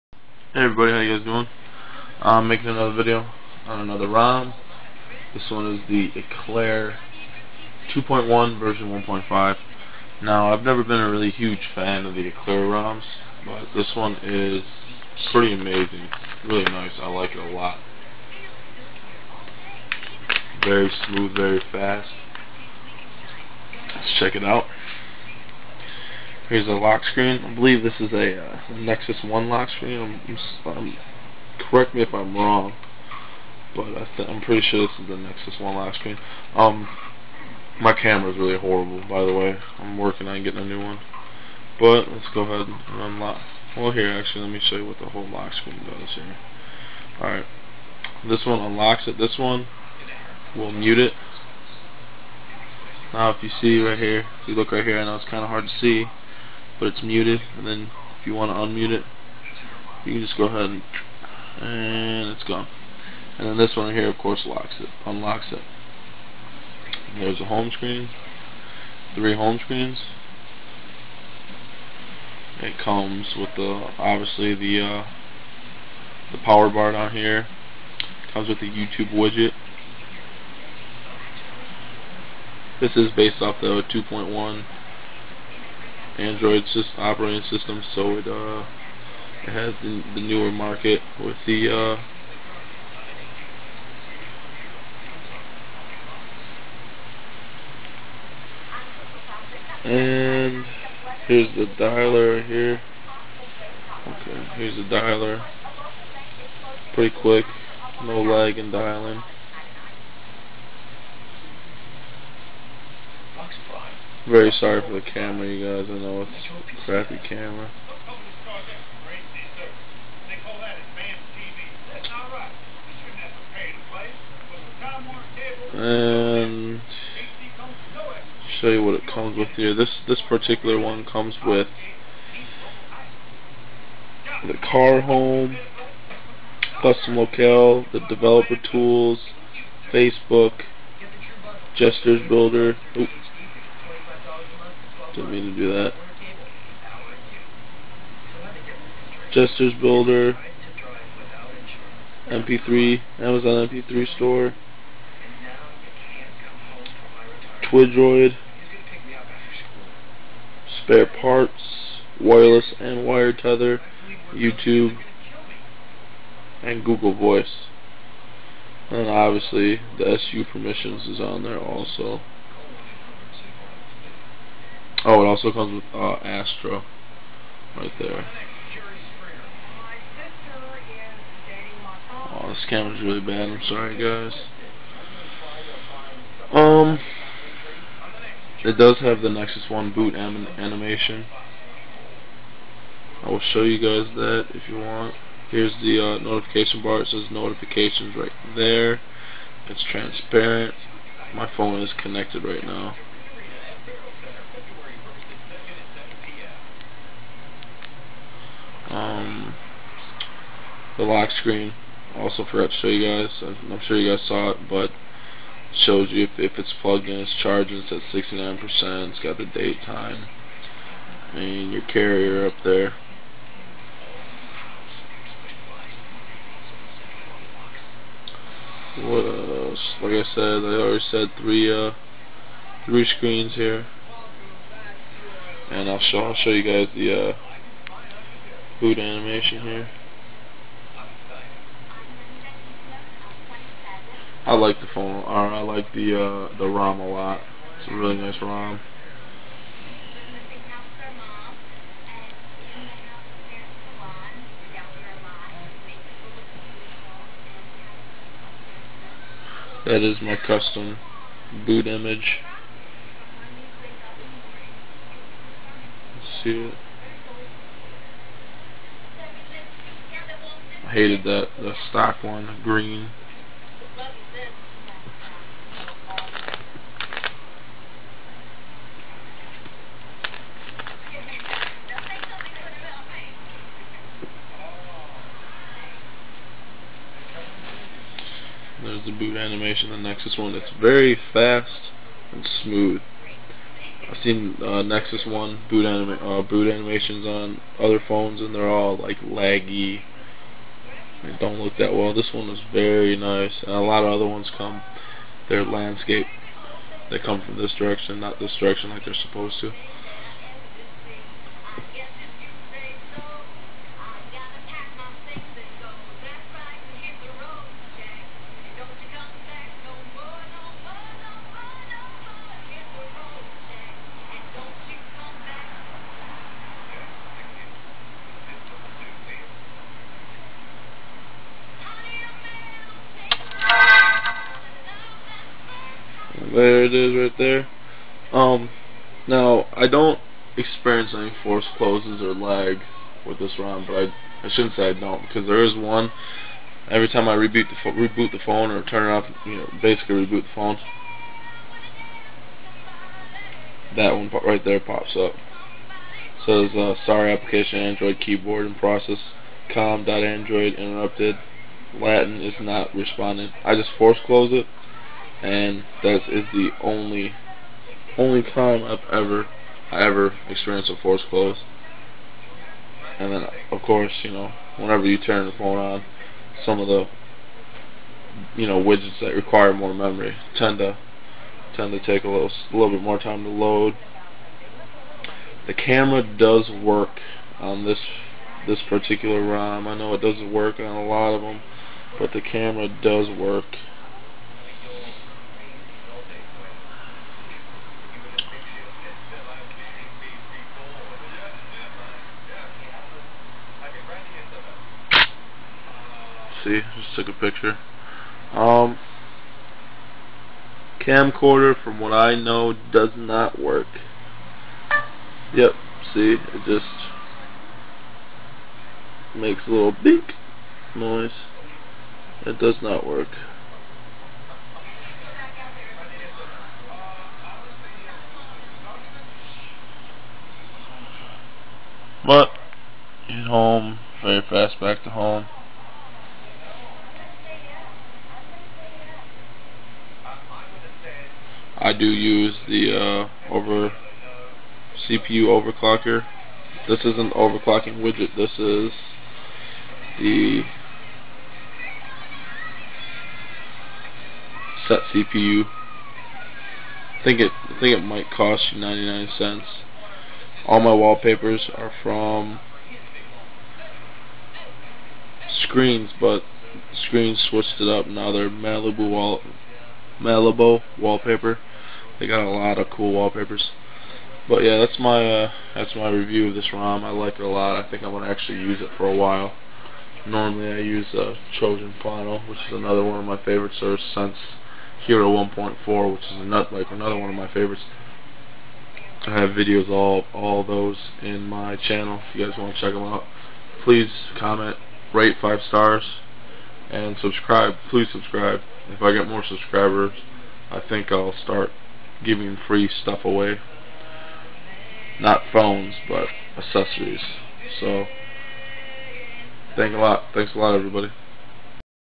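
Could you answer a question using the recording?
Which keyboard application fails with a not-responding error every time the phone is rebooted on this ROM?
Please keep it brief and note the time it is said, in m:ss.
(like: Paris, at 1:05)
Android keyboard, at 5:57.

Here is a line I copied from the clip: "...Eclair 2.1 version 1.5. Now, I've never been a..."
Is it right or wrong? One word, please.
right.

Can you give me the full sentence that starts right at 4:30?
hated the the stock one, green.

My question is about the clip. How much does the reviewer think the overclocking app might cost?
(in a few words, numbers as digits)
99 cents.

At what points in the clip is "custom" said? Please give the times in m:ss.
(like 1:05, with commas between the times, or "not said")
2:16, 4:20.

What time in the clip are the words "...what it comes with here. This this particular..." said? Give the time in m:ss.
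2:08.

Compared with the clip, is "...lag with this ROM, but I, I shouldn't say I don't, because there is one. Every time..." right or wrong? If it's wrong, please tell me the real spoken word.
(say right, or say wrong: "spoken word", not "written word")
right.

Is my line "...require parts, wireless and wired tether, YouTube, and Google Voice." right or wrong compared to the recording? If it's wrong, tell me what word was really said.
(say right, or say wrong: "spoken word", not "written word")
wrong: "spare", not "require".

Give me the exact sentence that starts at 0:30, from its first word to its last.
I'm, I'm, correct me if I'm wrong, but I am pretty sure this is the Nexus 1 lock screen.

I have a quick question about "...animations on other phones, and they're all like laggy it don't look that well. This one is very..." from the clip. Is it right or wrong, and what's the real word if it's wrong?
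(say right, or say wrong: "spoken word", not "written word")
right.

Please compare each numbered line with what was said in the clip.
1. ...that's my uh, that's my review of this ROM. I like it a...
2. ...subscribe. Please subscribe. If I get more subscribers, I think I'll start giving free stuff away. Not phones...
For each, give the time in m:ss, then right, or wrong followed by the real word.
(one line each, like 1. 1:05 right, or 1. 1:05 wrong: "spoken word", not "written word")
1. 7:54 right
2. 8:17 right.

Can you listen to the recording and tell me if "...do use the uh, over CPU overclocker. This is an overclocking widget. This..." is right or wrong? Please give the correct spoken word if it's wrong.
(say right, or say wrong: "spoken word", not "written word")
right.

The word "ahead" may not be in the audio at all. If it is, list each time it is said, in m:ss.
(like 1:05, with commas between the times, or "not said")
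0:42, 1:00.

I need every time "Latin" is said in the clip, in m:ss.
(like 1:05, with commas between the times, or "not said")
6:01.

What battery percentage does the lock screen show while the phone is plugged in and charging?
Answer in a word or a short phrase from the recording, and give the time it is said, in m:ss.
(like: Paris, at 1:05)
69%, at 3:38.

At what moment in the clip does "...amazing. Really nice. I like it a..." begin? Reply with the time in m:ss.
0:15.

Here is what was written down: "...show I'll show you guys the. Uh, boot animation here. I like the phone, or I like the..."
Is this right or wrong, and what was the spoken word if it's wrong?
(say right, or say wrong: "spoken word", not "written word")
right.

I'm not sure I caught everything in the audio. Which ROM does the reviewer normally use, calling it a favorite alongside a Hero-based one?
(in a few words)
Trojan Final.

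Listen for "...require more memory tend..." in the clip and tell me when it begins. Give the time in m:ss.
6:19.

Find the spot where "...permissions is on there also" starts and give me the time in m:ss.
2:50.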